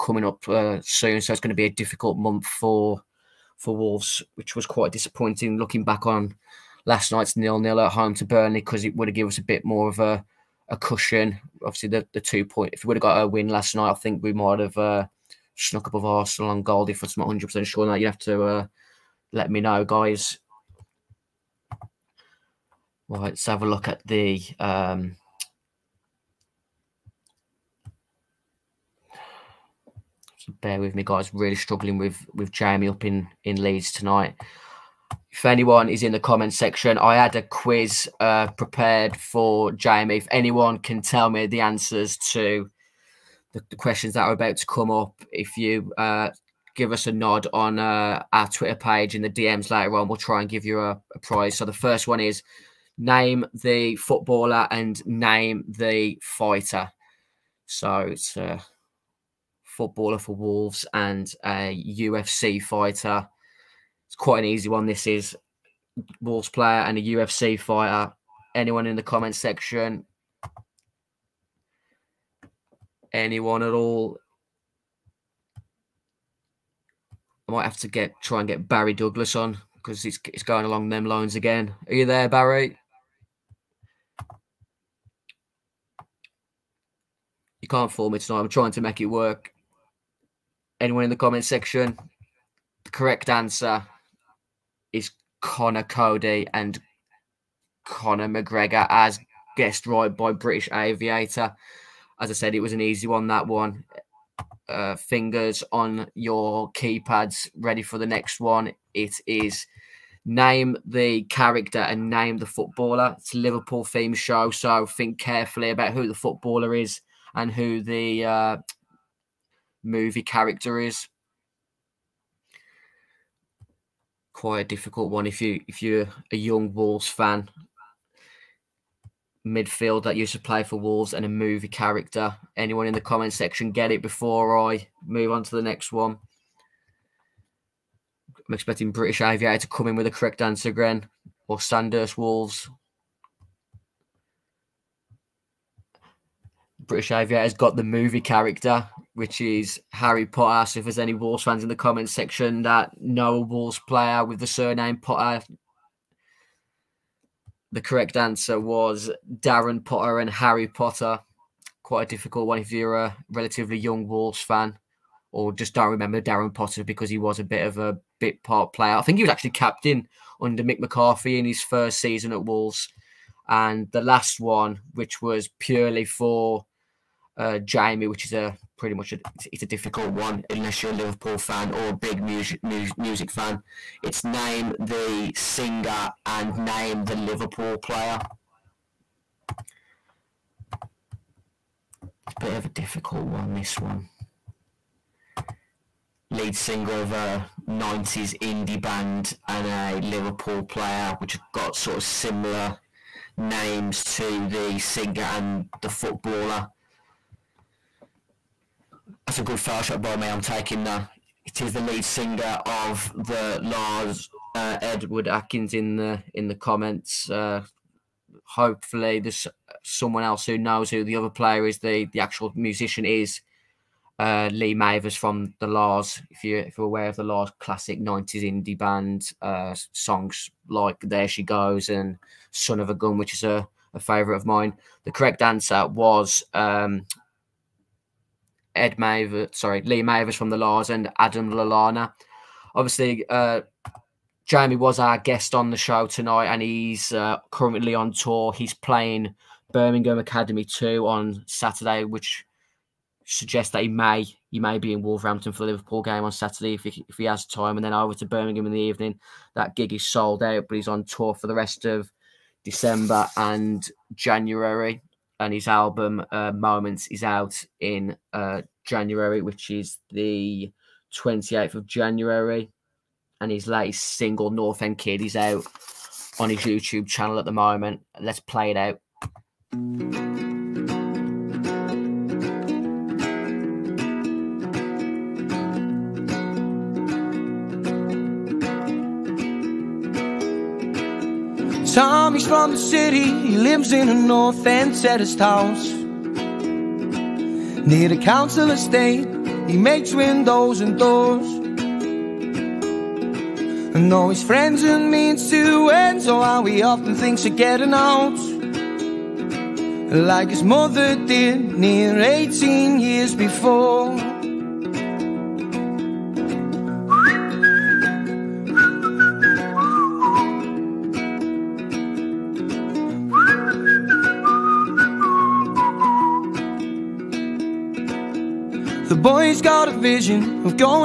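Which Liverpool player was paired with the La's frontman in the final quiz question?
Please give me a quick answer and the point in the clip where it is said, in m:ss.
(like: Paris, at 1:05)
Adam Lallana, at 4:01.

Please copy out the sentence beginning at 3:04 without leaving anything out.
It's name the singer and name the Liverpool player.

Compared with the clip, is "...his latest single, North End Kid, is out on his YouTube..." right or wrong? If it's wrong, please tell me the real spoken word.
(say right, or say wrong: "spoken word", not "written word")
right.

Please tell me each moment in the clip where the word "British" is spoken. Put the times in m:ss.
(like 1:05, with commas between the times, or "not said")
1:40, 2:18, 2:26.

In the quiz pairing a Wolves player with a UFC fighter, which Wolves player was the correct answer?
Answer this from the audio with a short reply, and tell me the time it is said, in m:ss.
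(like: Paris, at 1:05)
Conor Coady, at 1:35.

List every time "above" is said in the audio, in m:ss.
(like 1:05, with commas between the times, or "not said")
0:15.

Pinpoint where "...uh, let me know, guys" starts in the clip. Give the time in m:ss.
0:18.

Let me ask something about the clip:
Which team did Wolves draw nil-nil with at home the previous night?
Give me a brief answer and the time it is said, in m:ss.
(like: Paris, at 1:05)
Burnley, at 0:08.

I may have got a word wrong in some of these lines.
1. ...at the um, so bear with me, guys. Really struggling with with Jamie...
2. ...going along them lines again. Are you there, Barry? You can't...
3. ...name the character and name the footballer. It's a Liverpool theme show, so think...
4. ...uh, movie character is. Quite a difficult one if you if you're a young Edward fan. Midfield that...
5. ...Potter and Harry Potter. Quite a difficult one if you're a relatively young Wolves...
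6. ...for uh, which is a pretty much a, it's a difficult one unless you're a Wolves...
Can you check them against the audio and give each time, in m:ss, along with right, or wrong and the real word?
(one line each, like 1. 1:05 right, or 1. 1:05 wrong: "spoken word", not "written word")
1. 0:23 right
2. 1:20 right
3. 1:50 right
4. 1:58 wrong: "Wolves", not "Edward"
5. 2:39 right
6. 2:56 wrong: "Liverpool", not "Wolves".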